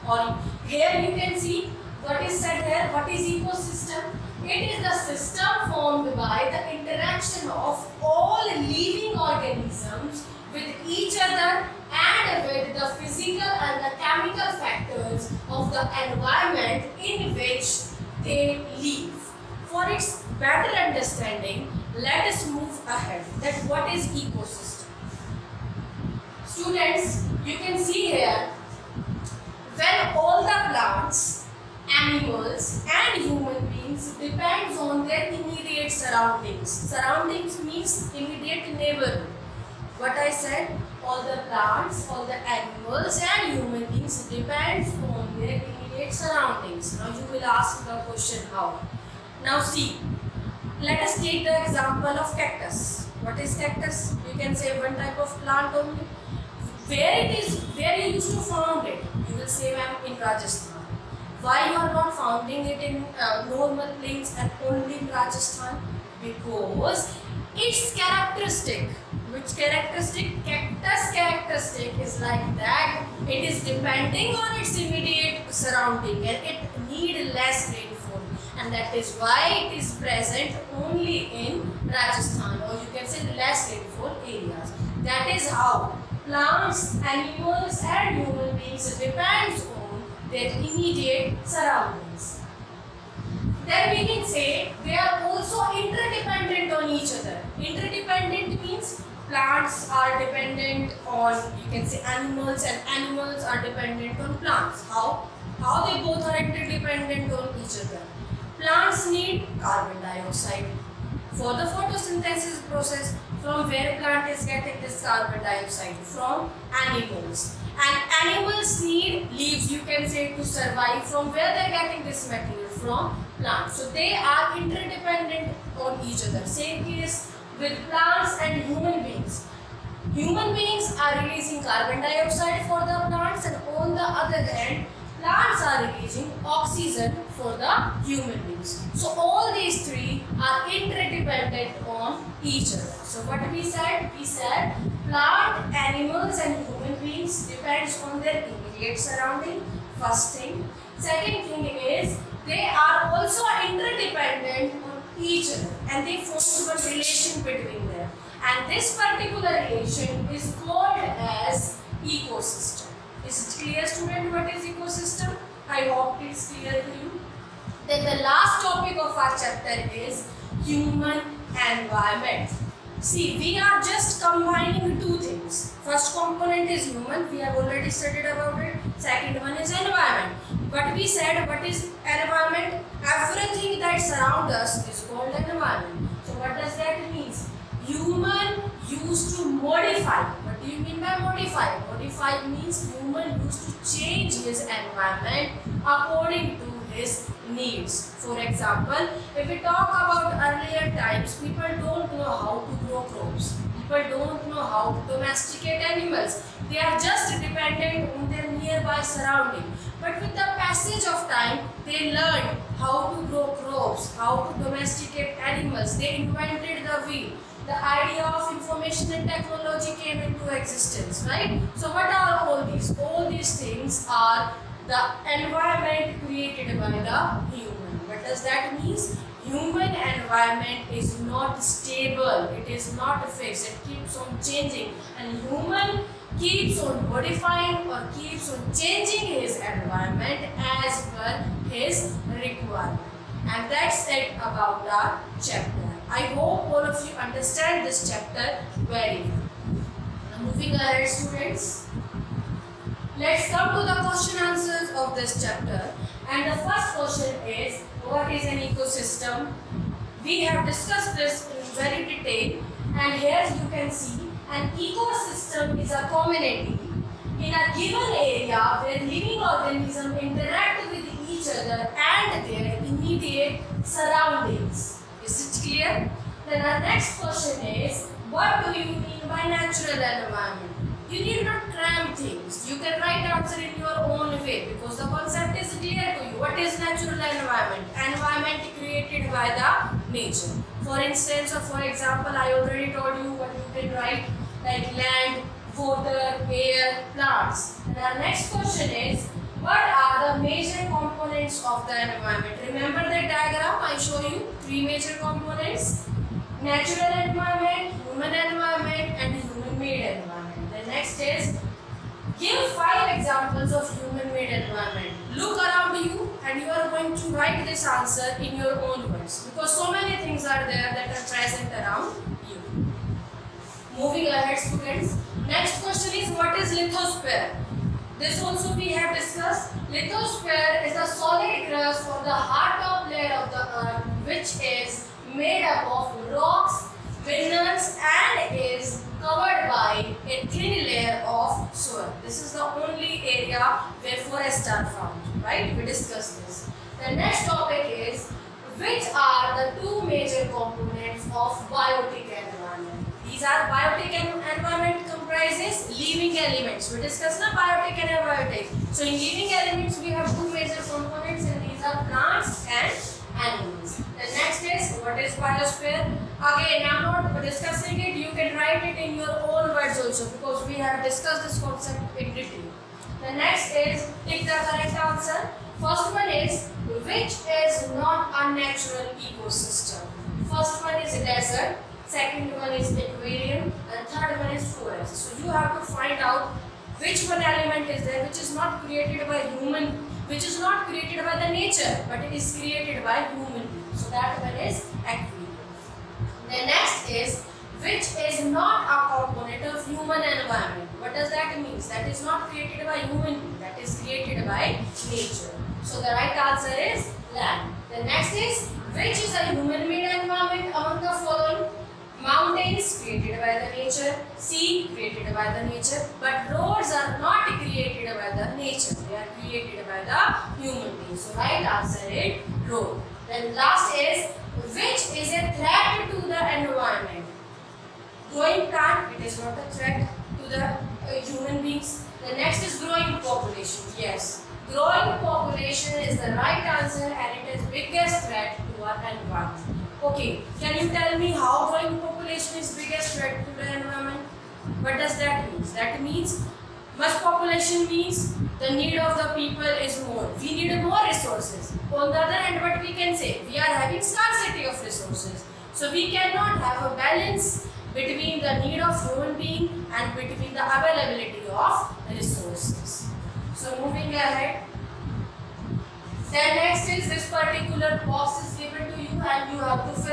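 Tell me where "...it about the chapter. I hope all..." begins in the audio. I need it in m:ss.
4:04.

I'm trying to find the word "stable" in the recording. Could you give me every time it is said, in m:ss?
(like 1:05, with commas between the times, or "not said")
3:51.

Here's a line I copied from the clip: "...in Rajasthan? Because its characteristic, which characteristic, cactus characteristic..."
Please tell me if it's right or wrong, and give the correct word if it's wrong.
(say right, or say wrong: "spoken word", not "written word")
right.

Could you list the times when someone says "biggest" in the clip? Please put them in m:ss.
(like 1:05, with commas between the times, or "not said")
7:17, 7:22.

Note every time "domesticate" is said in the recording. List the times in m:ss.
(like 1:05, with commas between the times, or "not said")
3:25, 3:34.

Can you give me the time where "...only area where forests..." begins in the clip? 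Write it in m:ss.
5:42.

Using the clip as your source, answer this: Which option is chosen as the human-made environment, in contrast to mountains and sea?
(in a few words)
Road.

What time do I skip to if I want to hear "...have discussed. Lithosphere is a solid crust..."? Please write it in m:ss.
5:28.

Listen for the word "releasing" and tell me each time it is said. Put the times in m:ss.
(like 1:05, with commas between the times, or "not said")
2:11, 2:15.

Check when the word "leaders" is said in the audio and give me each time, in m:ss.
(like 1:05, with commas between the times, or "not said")
not said.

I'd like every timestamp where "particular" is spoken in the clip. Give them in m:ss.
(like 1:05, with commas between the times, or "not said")
2:39, 7:47.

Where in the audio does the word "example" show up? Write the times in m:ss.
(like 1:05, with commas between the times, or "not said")
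0:51, 3:18, 4:51, 5:13.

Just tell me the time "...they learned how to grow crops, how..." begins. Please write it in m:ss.
3:31.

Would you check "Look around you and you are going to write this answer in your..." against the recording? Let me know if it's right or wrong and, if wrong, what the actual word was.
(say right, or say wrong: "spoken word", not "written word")
right.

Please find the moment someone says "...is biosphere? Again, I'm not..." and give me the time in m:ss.
6:05.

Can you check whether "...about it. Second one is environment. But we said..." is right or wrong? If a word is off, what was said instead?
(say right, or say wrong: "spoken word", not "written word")
right.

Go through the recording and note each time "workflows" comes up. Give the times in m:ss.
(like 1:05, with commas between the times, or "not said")
not said.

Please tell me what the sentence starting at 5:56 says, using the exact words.
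We discussed the biotic and abiotic.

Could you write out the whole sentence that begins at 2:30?
Second thing is they are also interdependent on each other and they form a relation between them.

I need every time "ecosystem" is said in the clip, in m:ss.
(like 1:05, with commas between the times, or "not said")
0:03, 0:24, 4:18, 4:24, 6:19.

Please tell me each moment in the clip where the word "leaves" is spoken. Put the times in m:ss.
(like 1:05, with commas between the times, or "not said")
1:59.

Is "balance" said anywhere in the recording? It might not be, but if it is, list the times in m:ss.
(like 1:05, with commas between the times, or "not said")
7:36.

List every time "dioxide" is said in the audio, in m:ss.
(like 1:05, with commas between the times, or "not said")
1:50, 1:55, 2:12.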